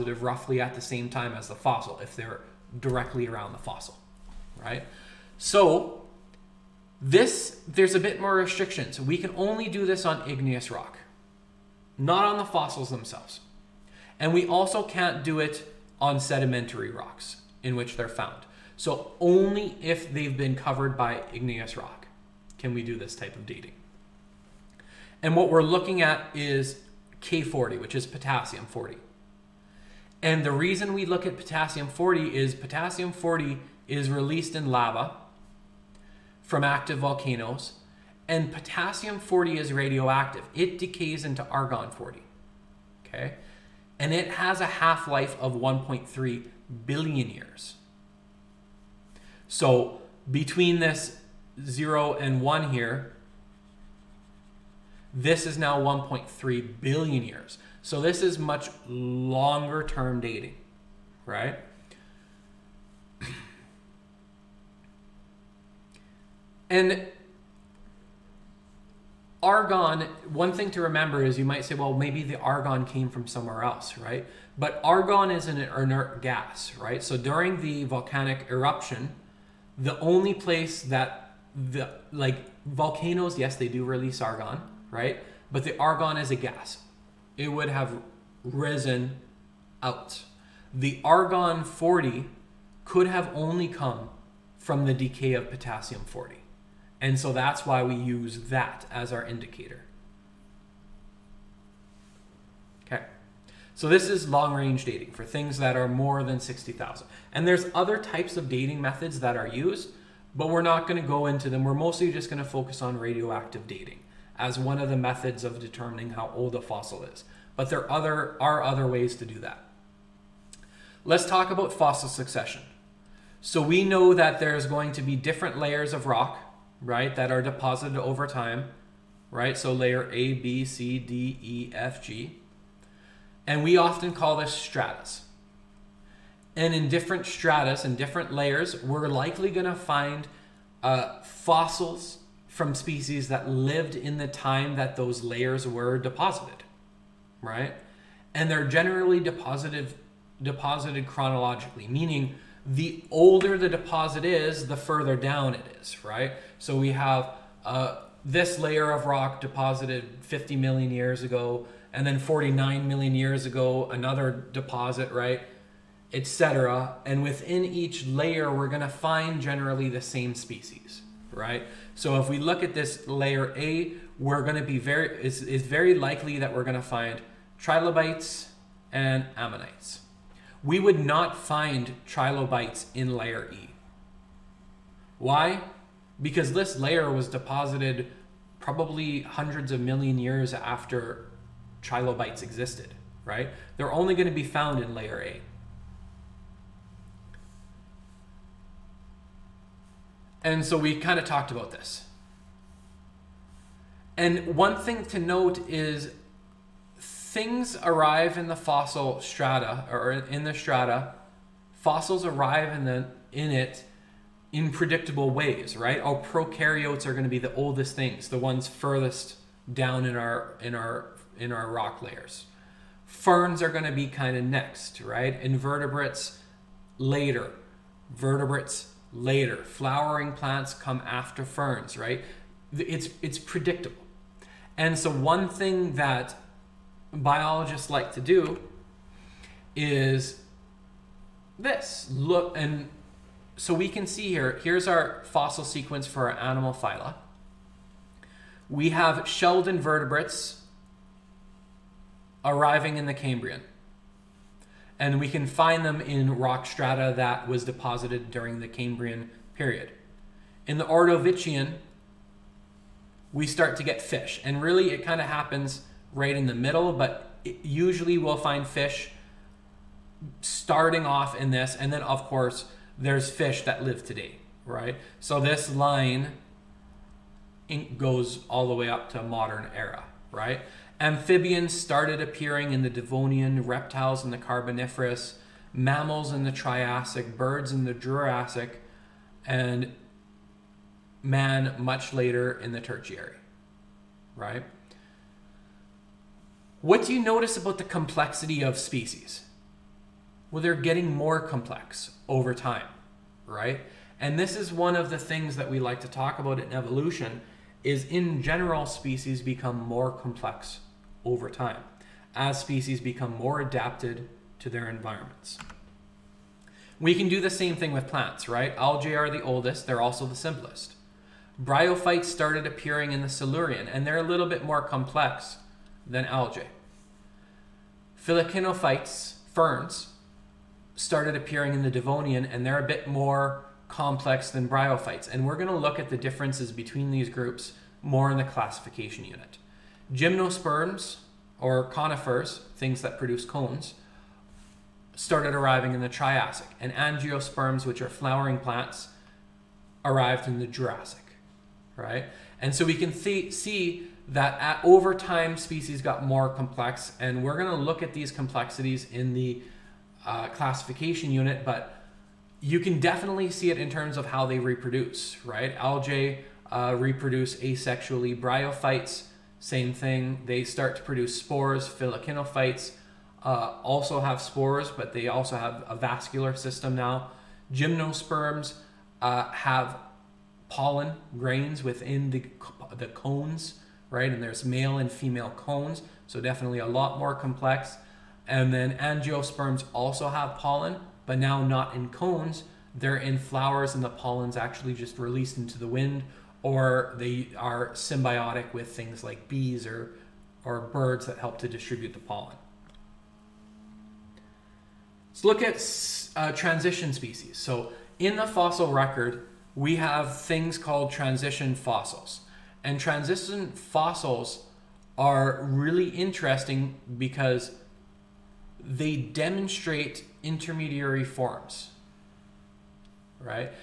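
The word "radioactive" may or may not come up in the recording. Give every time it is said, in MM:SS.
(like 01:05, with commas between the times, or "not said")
00:39, 01:52.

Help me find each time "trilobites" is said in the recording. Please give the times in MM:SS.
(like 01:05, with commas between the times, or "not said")
02:57, 03:02, 03:11.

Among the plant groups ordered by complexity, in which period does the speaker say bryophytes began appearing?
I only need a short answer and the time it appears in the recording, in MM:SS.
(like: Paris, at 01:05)
Silurian, at 05:21.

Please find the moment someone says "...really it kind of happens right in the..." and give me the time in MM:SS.
04:24.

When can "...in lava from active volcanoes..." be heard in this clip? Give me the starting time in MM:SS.
00:34.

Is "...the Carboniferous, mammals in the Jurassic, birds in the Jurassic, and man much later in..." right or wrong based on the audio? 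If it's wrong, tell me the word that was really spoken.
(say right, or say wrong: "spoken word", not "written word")
wrong: "Triassic", not "Jurassic".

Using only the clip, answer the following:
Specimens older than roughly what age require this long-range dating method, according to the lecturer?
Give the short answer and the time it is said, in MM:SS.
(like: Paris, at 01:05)
60,000, at 01:46.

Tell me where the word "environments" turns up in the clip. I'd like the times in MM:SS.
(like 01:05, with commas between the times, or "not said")
05:14.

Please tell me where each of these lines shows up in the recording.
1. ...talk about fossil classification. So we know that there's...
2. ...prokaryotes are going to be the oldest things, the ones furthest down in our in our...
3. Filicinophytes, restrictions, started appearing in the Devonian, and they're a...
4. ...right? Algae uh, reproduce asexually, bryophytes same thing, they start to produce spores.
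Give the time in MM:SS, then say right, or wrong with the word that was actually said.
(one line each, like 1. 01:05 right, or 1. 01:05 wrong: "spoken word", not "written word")
1. 02:01 wrong: "succession", not "classification"
2. 03:36 right
3. 05:28 wrong: "ferns", not "restrictions"
4. 06:05 right.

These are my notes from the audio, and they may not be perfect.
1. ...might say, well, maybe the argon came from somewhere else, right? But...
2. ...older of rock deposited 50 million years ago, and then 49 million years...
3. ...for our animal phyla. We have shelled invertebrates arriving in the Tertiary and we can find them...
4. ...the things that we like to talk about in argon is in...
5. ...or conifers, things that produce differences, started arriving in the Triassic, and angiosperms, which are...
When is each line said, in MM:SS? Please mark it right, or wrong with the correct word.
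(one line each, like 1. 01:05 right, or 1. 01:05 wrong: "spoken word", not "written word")
1. 01:11 right
2. 02:38 wrong: "layer", not "older"
3. 04:06 wrong: "Cambrian", not "Tertiary"
4. 05:05 wrong: "evolution", not "argon"
5. 05:41 wrong: "cones", not "differences".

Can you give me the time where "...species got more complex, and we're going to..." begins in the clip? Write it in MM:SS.
05:55.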